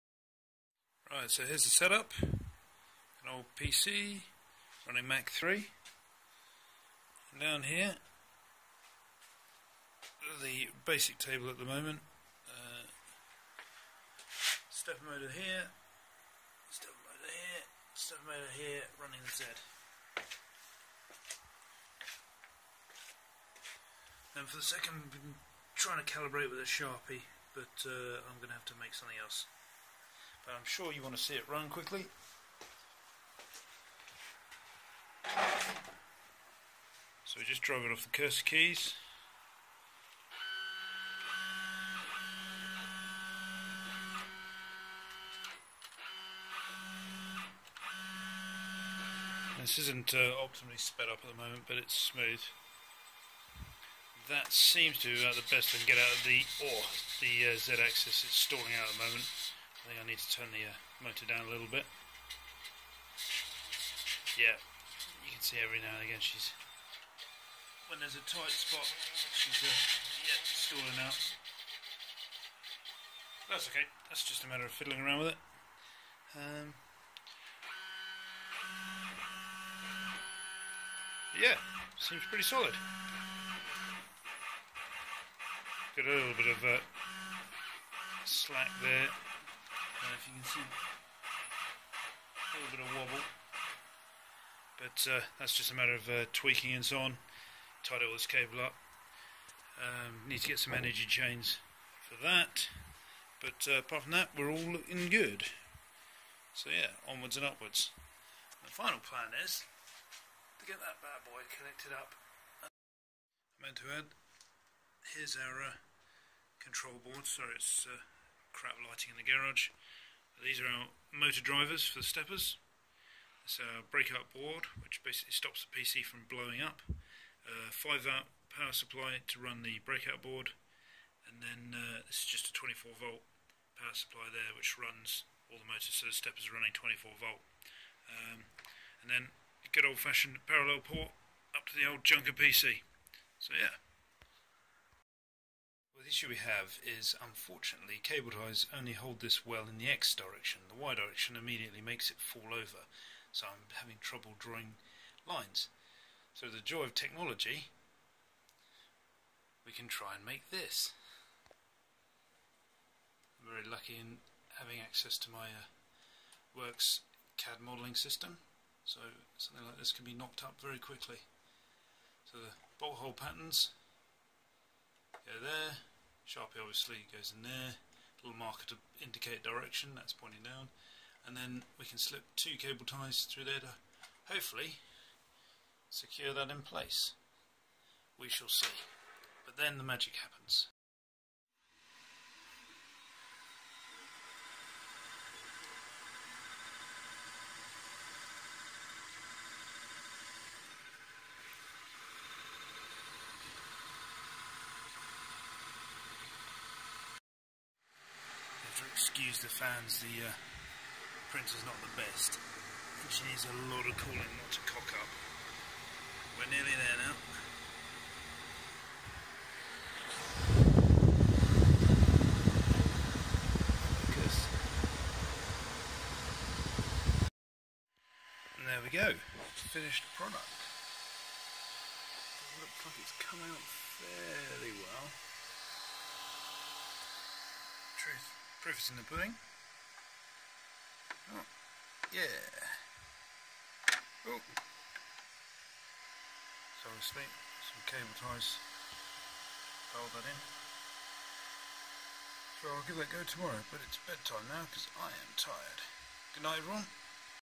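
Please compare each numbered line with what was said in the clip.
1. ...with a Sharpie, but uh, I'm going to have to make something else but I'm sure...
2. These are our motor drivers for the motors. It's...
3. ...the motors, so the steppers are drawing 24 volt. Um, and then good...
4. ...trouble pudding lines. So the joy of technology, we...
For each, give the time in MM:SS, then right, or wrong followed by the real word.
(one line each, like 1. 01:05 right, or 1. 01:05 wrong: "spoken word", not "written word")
1. 00:26 right
2. 02:00 wrong: "steppers", not "motors"
3. 02:15 wrong: "running", not "drawing"
4. 02:34 wrong: "drawing", not "pudding".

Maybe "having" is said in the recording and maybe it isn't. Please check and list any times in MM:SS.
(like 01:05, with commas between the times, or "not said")
02:33, 02:44.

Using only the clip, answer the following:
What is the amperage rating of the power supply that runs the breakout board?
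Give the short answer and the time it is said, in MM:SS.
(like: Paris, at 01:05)
5 amp, at 02:07.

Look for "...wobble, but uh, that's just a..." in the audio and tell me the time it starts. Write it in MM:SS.
01:32.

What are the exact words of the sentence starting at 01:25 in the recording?
Got a little bit of uh, slack there.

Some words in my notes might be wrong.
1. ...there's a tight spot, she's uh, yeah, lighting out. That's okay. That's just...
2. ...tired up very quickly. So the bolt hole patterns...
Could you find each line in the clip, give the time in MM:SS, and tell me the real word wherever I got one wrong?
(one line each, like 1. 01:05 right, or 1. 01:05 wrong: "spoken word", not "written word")
1. 01:07 wrong: "stalling", not "lighting"
2. 02:50 wrong: "knocked", not "tired".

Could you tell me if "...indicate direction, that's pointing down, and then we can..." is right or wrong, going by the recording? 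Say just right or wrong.
right.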